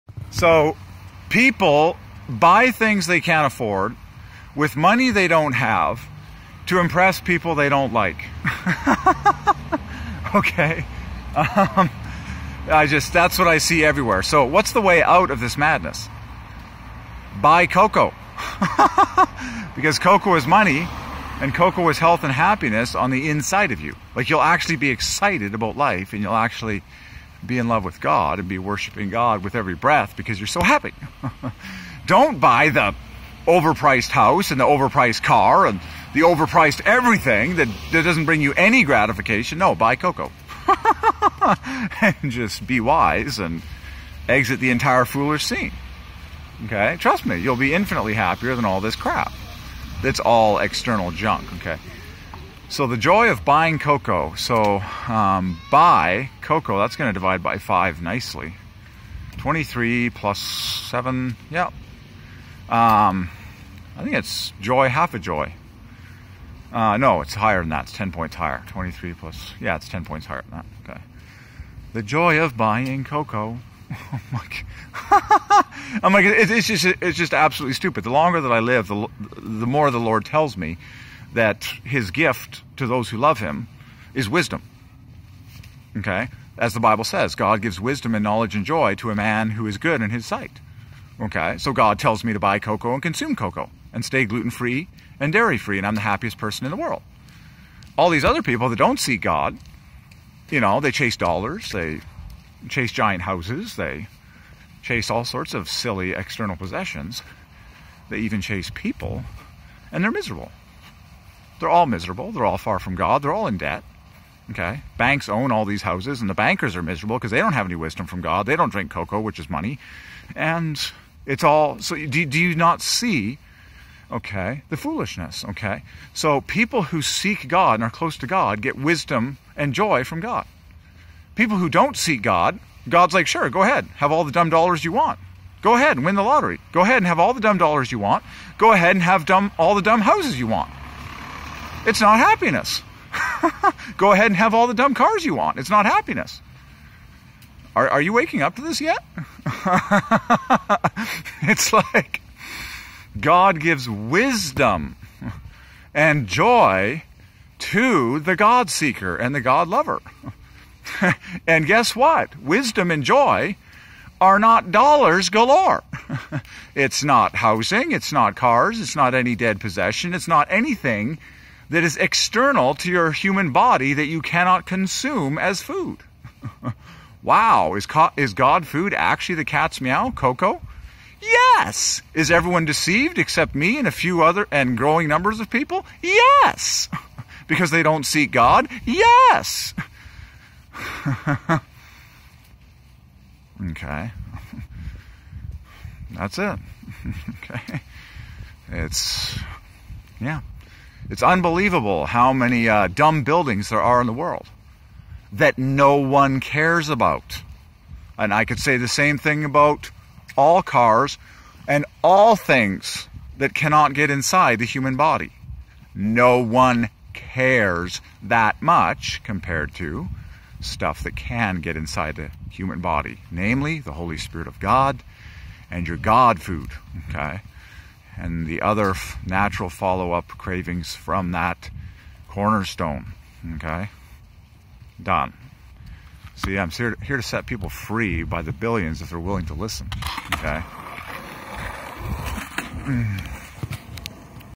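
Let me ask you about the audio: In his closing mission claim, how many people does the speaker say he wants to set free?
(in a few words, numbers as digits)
billions.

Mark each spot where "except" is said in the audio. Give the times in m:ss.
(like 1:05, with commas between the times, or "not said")
3:03.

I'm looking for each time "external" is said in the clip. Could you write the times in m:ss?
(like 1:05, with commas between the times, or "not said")
0:50, 1:46, 2:51.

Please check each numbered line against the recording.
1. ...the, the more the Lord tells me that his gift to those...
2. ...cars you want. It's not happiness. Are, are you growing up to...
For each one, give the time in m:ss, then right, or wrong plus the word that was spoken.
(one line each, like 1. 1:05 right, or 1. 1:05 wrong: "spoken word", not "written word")
1. 1:18 right
2. 2:24 wrong: "waking", not "growing".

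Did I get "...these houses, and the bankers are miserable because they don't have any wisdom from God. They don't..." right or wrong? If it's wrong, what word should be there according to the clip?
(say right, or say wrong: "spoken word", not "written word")
right.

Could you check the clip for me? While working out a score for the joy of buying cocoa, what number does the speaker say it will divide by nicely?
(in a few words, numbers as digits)
5.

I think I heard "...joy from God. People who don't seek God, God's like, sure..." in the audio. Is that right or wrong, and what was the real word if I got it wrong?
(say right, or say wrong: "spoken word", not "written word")
right.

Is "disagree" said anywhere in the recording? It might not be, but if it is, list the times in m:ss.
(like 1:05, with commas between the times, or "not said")
not said.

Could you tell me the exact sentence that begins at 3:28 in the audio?
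And I could say the same thing about all cars and all things that cannot get inside the human body.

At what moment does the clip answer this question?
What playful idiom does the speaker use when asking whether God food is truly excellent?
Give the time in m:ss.
2:59.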